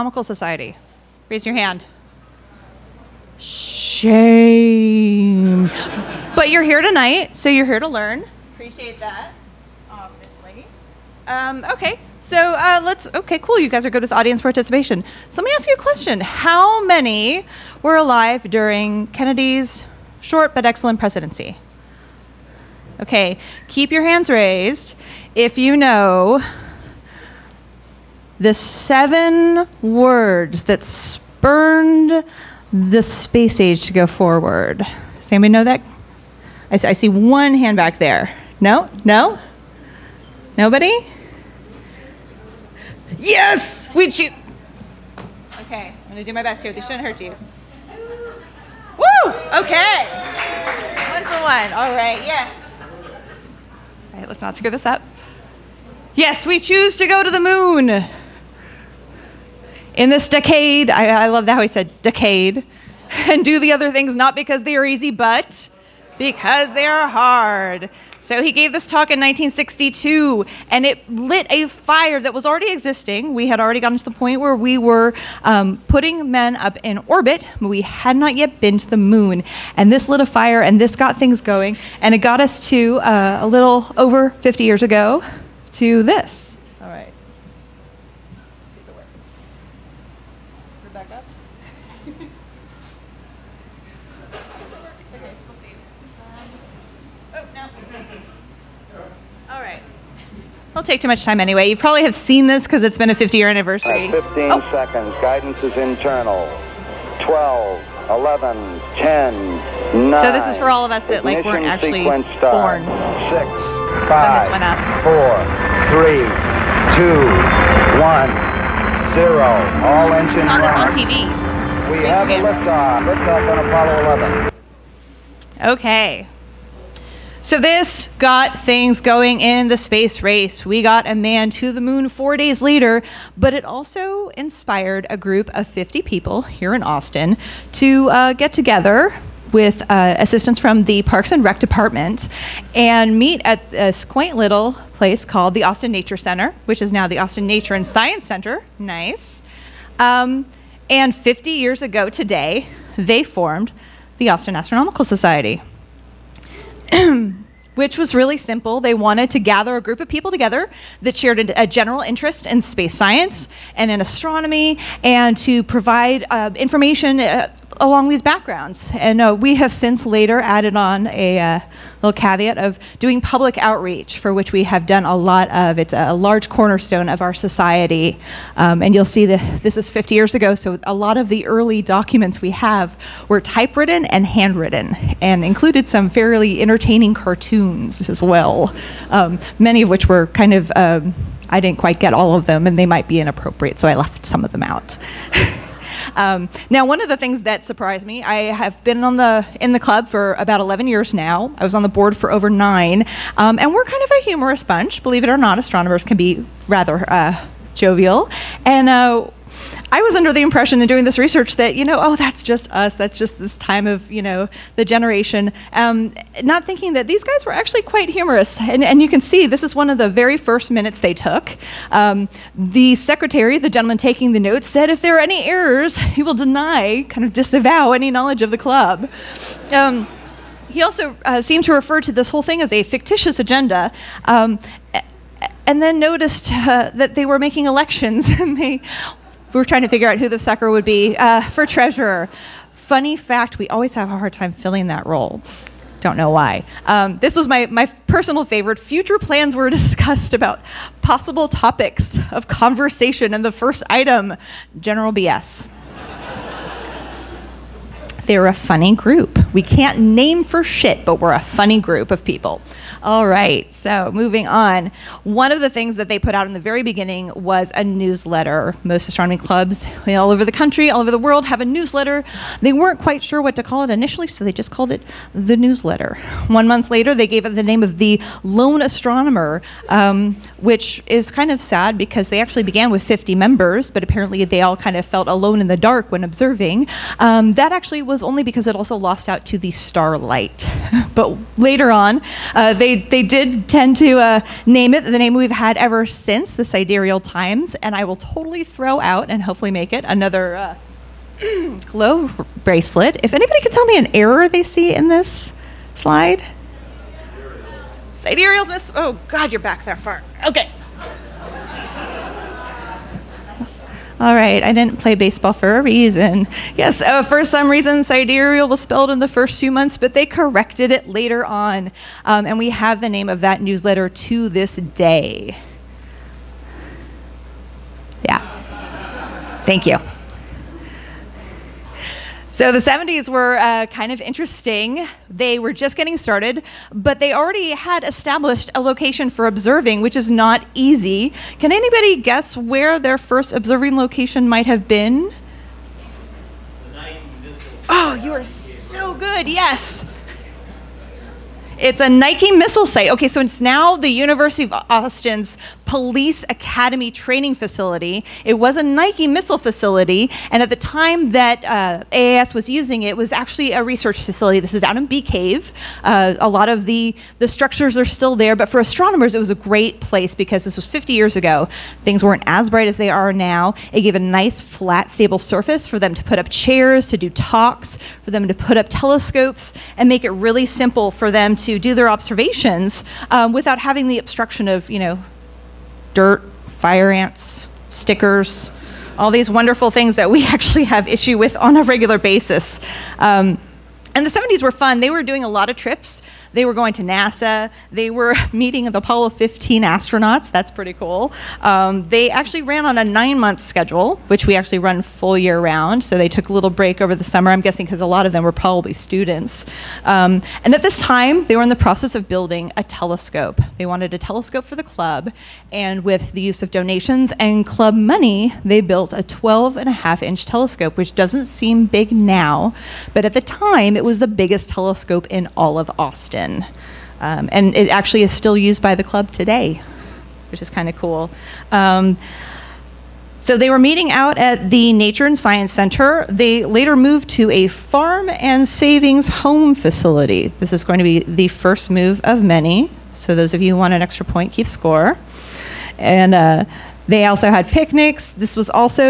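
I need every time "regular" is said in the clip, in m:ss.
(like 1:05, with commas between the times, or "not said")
6:31.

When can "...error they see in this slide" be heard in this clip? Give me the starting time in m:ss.
5:04.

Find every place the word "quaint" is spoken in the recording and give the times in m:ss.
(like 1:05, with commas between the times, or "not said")
2:24.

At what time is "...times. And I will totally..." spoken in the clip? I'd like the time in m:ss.
4:57.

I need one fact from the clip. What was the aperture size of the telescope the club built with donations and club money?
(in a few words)
12.5 inch.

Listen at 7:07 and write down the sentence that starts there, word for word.
Um, and it actually is still used by the club today, which is kind of cool.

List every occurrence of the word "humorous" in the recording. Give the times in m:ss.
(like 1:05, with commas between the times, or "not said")
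3:24, 3:38.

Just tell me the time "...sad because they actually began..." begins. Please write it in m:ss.
4:41.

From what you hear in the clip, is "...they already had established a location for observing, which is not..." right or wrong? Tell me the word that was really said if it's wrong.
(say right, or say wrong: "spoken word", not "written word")
right.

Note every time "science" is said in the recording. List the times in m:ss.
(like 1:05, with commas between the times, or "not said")
2:27, 2:42, 7:15.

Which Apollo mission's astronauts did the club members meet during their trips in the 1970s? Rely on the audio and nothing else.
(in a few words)
Apollo 15.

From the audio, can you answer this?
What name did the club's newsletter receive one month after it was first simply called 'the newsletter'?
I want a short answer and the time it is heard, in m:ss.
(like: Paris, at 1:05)
the Lone Astronomer, at 4:37.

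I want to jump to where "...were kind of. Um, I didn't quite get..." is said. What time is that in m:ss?
3:10.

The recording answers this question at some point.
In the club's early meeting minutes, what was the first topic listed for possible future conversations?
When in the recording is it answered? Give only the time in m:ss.
4:14.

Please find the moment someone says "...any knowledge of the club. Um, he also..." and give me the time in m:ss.
3:47.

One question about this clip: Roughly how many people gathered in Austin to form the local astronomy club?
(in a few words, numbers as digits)
50.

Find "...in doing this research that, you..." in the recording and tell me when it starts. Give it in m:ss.
3:30.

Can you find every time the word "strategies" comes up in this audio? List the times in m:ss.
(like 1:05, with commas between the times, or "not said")
not said.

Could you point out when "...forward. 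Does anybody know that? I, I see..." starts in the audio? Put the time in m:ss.
0:34.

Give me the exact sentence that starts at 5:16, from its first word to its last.
Yes, uh, for some reason, sidereal was spelled in the first few months, but they corrected it later on.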